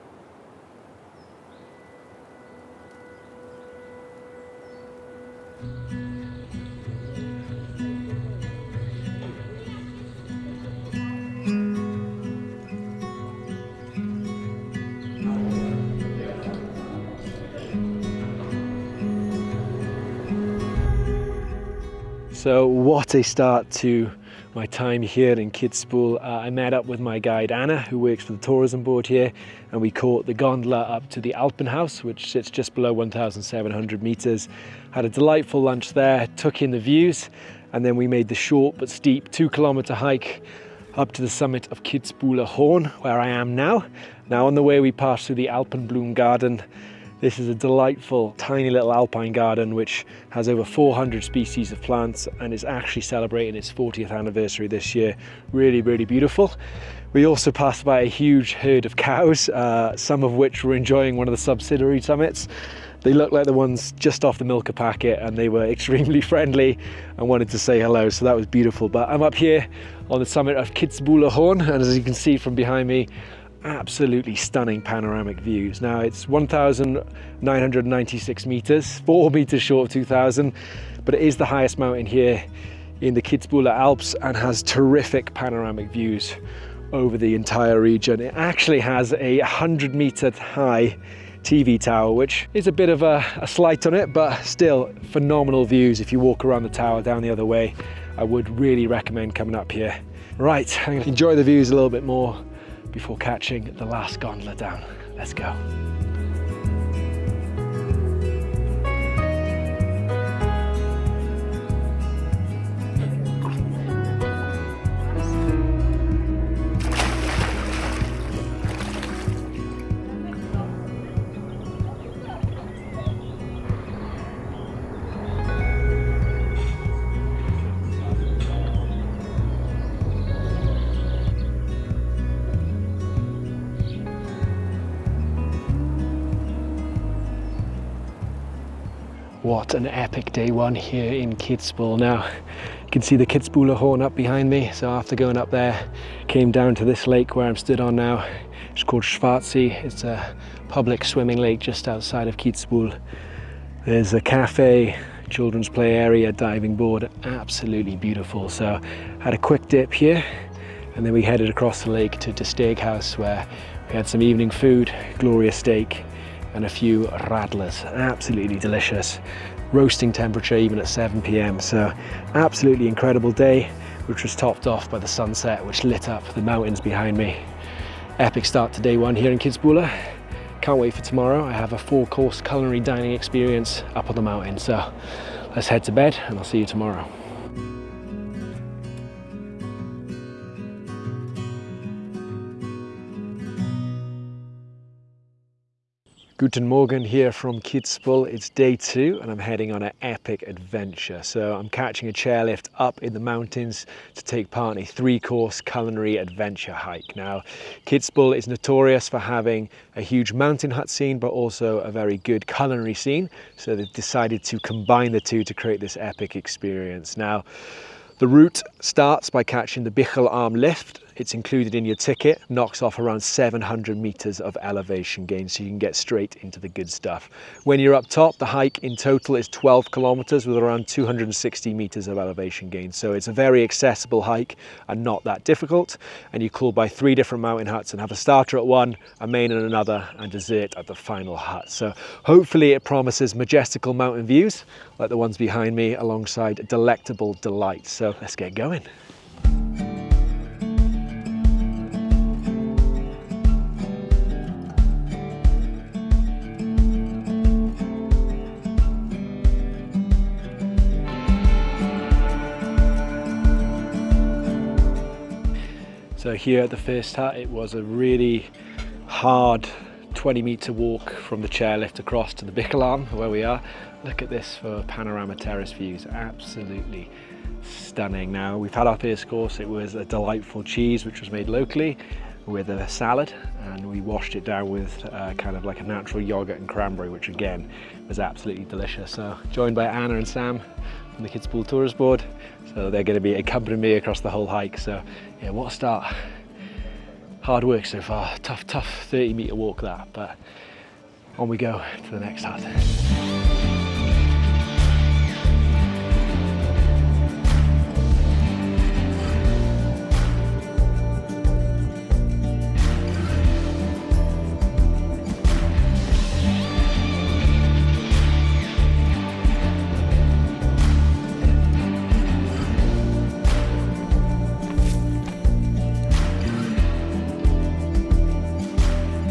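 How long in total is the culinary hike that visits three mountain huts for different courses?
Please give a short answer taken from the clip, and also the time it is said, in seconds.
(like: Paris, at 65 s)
12 kilometers, at 229 s.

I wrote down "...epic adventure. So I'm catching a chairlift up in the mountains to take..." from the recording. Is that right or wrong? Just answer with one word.
right.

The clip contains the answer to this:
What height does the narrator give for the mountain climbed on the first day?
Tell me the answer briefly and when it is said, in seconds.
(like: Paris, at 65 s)
1,996 meters, at 76 s.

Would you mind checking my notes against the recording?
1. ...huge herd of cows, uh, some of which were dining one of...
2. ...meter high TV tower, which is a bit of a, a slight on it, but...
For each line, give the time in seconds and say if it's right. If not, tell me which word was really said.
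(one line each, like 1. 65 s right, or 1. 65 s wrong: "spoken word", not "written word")
1. 58 s wrong: "enjoying", not "dining"
2. 89 s right.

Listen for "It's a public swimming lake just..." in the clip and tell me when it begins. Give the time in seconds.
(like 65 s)
149 s.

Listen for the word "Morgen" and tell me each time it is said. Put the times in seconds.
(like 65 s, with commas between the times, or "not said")
196 s.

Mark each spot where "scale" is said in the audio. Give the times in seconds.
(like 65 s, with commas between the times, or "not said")
not said.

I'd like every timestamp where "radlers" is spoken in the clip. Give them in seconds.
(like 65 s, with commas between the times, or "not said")
167 s.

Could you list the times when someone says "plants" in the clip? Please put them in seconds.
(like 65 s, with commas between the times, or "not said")
51 s.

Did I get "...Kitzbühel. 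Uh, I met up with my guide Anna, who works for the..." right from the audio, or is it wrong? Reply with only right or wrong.
right.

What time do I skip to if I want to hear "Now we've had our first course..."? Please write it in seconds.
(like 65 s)
278 s.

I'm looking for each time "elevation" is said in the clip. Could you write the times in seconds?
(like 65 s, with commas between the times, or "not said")
224 s, 232 s.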